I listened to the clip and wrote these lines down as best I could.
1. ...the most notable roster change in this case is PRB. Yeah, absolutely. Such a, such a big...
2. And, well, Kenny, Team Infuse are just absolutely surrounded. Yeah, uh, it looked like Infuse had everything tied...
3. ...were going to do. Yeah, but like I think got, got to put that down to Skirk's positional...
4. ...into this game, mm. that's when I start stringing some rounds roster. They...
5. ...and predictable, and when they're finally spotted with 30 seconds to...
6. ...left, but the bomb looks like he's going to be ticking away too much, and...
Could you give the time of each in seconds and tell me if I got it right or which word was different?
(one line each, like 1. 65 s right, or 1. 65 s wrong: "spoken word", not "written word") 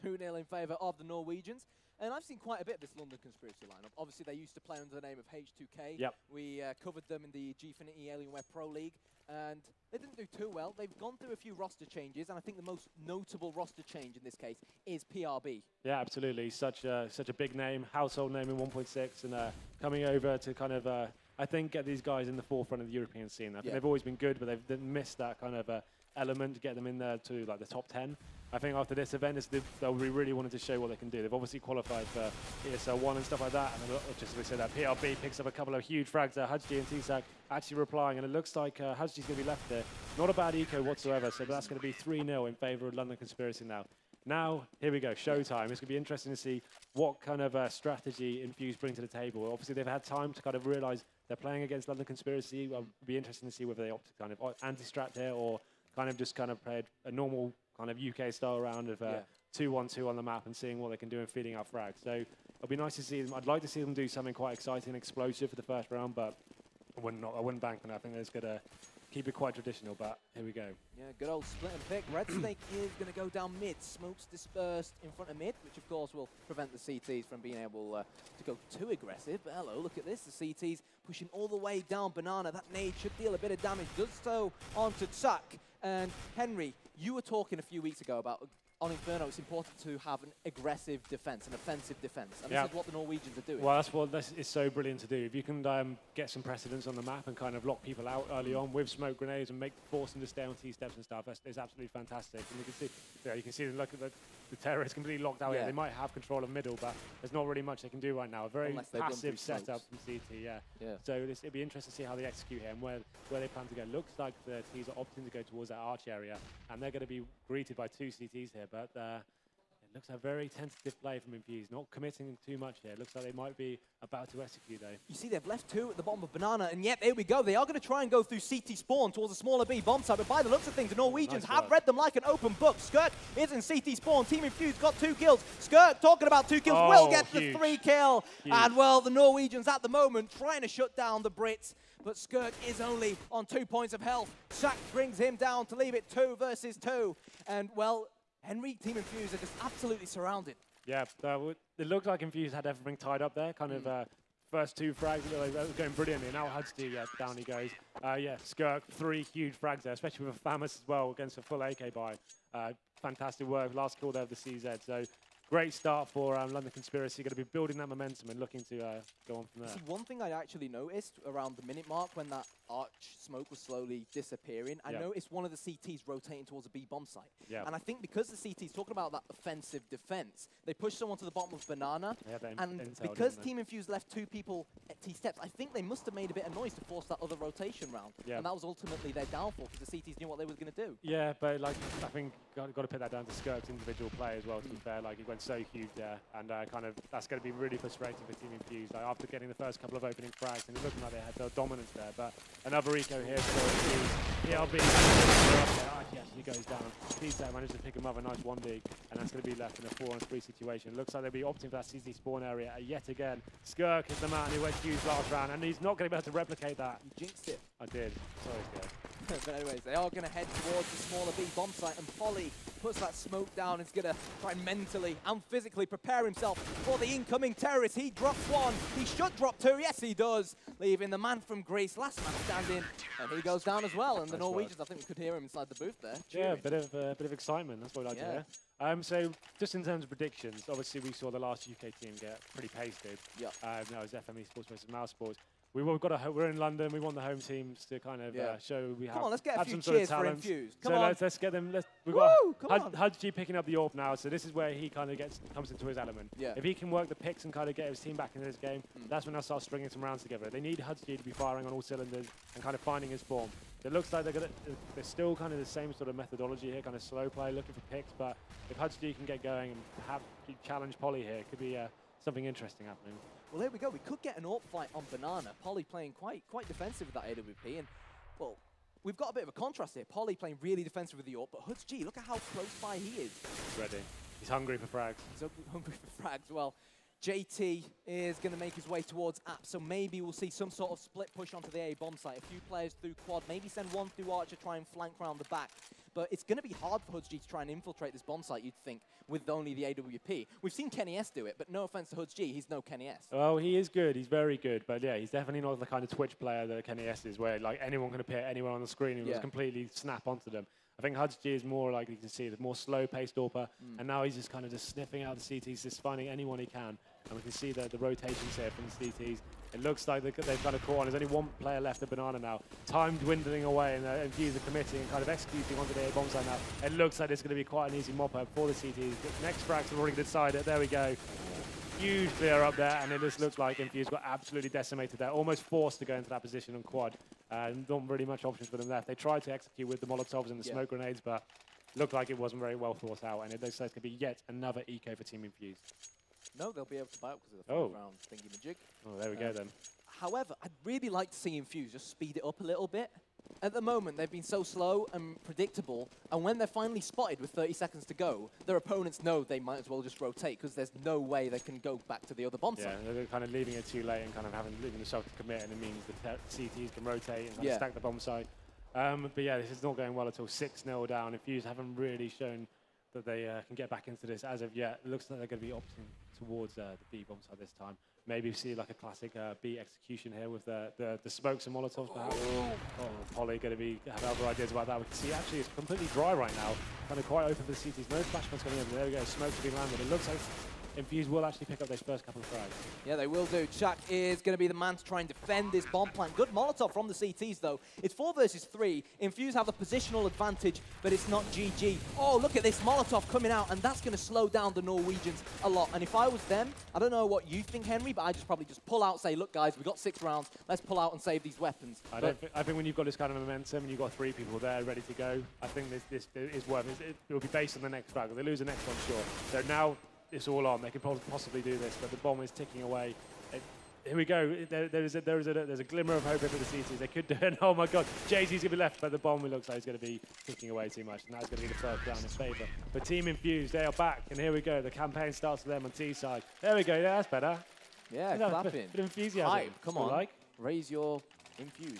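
1. 12 s right
2. 147 s wrong: "Henry", not "Kenny"
3. 190 s wrong: "individual", not "positional"
4. 258 s wrong: "together", not "roster"
5. 355 s right
6. 428 s right.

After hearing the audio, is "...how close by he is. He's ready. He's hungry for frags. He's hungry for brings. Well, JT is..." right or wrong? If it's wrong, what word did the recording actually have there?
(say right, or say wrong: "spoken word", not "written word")
wrong: "frags", not "brings".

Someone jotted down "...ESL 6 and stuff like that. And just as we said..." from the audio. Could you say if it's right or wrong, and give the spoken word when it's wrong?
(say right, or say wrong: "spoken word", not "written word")
wrong: "1", not "6".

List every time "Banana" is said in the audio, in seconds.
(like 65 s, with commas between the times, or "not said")
82 s, 126 s, 181 s, 275 s, 322 s.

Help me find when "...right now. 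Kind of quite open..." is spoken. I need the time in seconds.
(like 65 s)
386 s.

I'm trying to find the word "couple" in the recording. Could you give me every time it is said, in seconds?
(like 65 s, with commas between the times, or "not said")
35 s, 199 s, 392 s.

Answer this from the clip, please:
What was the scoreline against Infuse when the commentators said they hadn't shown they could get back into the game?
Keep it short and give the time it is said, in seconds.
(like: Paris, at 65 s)
6-0, at 370 s.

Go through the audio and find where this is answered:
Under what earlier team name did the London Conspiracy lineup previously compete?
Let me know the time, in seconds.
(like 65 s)
5 s.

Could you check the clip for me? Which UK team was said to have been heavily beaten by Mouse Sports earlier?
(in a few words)
FME Sports.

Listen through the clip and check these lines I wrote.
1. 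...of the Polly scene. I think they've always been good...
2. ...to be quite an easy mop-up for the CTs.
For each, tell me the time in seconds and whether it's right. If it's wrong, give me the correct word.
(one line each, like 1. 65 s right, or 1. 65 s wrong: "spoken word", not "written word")
1. 22 s wrong: "European", not "Polly"
2. 327 s right.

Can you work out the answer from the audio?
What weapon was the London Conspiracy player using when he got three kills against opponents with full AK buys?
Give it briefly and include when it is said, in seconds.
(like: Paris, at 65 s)
Famas, at 160 s.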